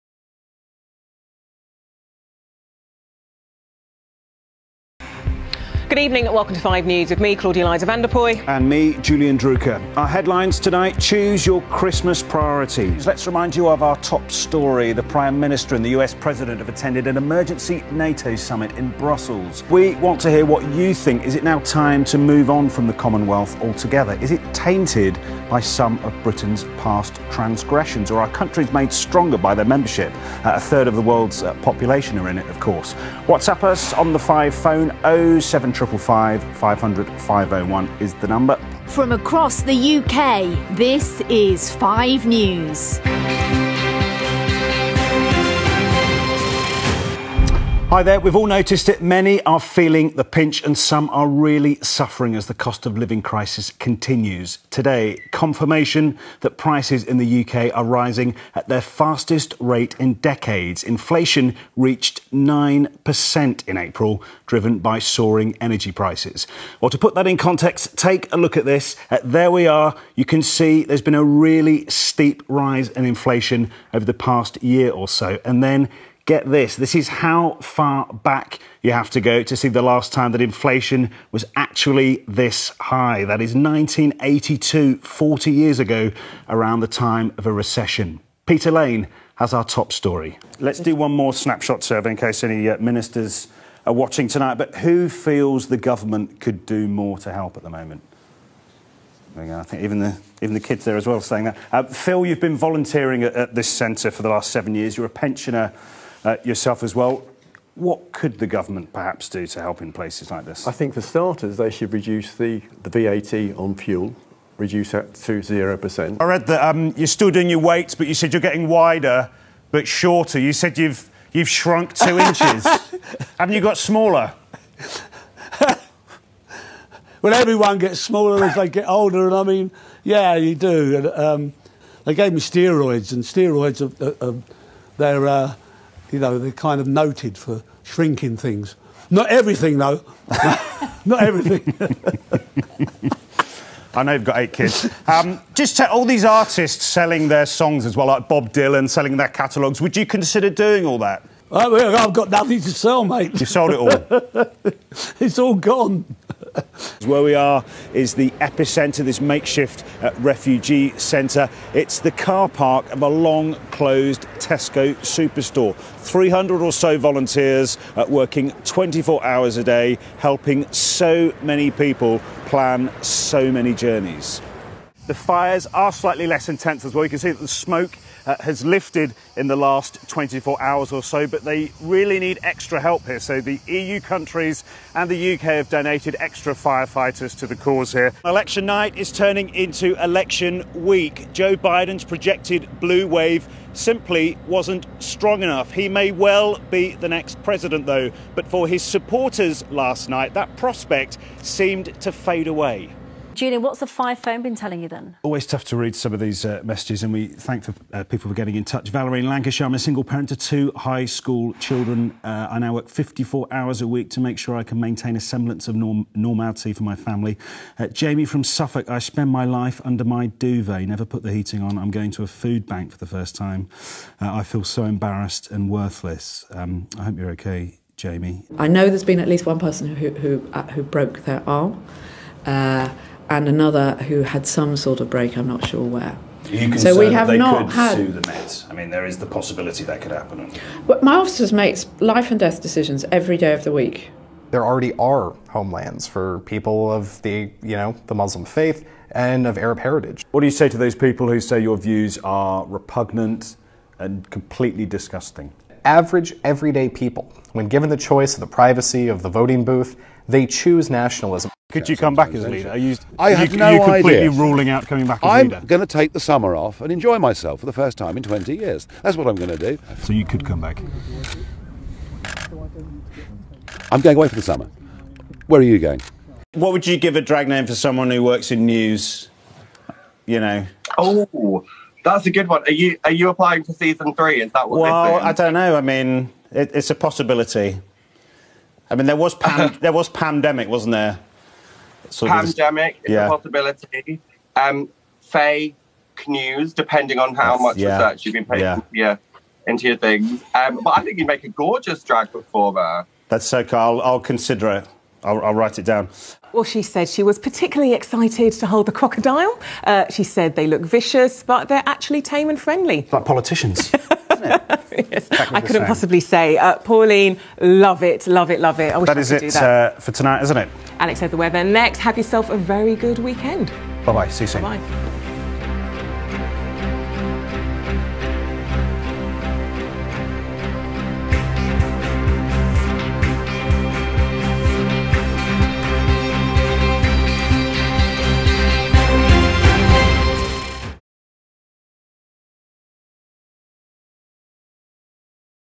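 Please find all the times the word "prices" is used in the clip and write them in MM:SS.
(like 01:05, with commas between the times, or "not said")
00:56, 01:05.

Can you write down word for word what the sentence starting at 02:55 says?
The fires are slightly less intense as well.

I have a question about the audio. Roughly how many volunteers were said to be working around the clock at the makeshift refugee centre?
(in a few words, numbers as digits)
300.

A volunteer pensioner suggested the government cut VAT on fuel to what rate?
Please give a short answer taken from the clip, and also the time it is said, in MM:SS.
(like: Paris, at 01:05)
0%, at 01:55.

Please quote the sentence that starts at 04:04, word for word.
There already are homelands for people of the, you know, the Muslim faith and of Arab heritage.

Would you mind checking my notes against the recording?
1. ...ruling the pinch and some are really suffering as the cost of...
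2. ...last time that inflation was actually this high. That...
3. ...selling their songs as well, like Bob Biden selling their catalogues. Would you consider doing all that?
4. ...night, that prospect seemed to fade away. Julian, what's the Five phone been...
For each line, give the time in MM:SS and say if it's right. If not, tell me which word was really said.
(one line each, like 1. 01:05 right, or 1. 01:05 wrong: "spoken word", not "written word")
1. 00:49 wrong: "feeling", not "ruling"
2. 01:19 right
3. 02:26 wrong: "Dylan", not "Biden"
4. 03:20 right.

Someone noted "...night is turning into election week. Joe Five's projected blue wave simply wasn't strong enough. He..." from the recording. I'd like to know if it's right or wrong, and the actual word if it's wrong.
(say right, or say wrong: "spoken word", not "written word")
wrong: "Biden", not "Five".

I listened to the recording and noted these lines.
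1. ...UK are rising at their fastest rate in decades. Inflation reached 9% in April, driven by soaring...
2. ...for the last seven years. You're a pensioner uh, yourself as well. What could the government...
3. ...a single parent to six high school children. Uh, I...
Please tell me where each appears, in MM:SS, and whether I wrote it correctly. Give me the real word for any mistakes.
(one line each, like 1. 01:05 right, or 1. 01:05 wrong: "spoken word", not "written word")
1. 00:57 right
2. 01:44 right
3. 03:29 wrong: "two", not "six".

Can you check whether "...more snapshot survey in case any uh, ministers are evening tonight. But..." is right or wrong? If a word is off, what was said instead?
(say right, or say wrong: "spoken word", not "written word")
wrong: "watching", not "evening".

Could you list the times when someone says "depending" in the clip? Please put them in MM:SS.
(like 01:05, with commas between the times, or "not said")
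04:56.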